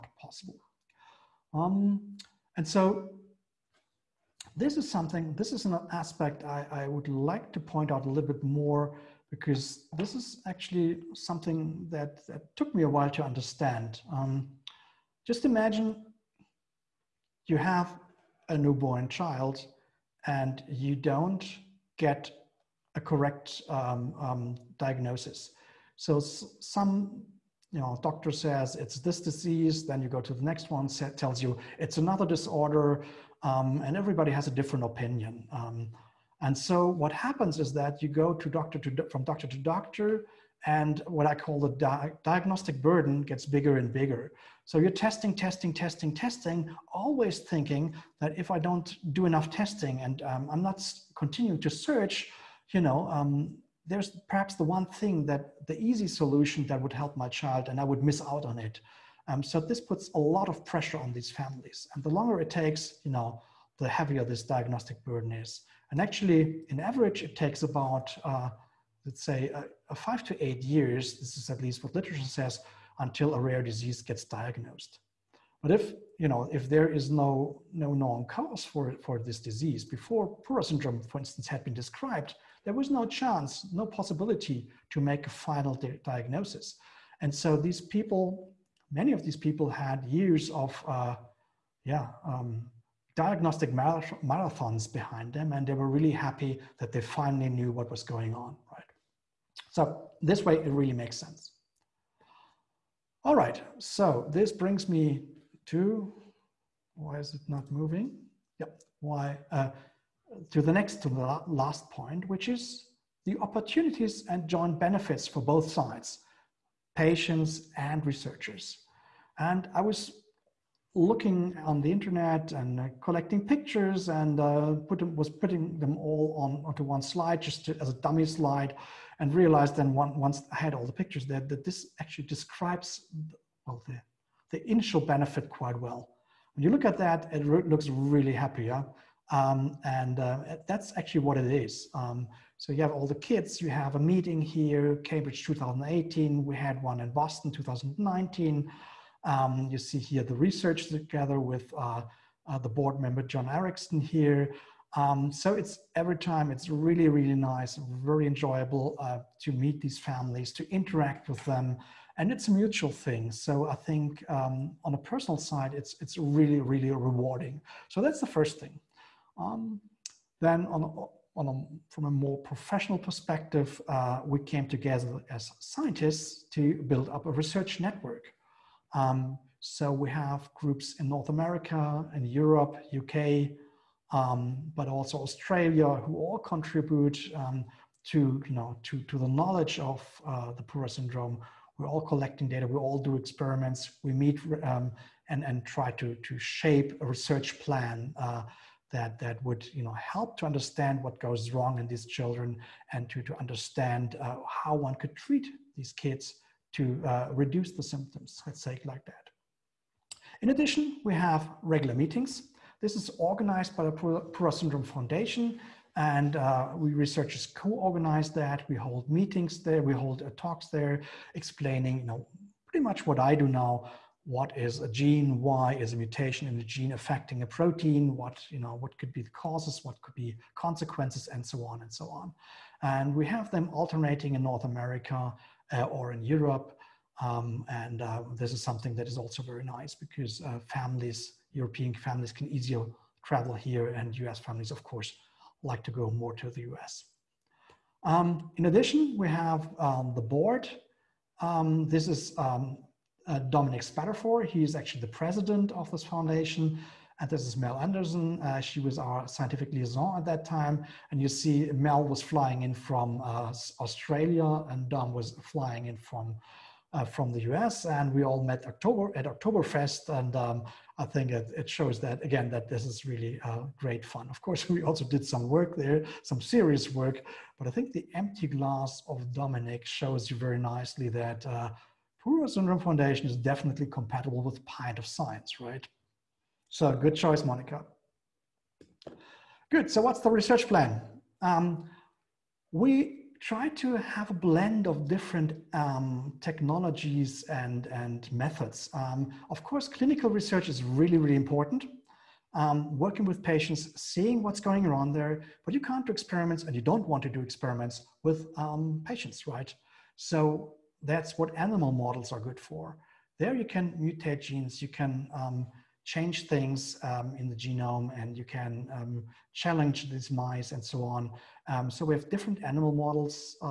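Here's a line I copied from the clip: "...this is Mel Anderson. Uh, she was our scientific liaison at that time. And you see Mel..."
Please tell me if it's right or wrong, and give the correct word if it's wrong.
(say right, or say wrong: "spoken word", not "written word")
right.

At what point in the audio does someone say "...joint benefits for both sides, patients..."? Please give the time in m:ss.
1:54.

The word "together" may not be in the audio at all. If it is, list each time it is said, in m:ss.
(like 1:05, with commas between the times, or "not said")
2:30, 2:54.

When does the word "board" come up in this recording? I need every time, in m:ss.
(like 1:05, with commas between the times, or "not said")
2:32, 4:10.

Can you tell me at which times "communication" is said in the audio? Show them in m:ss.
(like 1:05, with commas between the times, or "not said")
not said.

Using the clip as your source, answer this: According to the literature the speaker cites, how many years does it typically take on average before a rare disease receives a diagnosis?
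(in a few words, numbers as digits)
5 to 8 years.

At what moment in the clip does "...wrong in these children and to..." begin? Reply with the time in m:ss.
3:21.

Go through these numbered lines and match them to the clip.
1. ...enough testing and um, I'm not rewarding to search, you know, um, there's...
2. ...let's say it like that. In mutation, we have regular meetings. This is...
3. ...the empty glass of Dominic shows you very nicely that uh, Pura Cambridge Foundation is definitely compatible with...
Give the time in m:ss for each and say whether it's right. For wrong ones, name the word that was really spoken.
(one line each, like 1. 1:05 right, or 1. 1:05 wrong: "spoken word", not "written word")
1. 0:49 wrong: "continuing", not "rewarding"
2. 3:28 wrong: "addition", not "mutation"
3. 4:37 wrong: "Syndrome", not "Cambridge".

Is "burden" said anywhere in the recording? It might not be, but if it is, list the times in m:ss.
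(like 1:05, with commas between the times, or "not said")
0:42, 1:05.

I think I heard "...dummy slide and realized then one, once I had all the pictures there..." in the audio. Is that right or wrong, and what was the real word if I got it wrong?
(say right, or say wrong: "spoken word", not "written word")
right.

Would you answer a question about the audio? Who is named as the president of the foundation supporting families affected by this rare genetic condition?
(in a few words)
Dominic Spadafore.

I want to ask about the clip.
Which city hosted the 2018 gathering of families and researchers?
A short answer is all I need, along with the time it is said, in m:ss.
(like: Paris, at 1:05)
Cambridge, at 2:25.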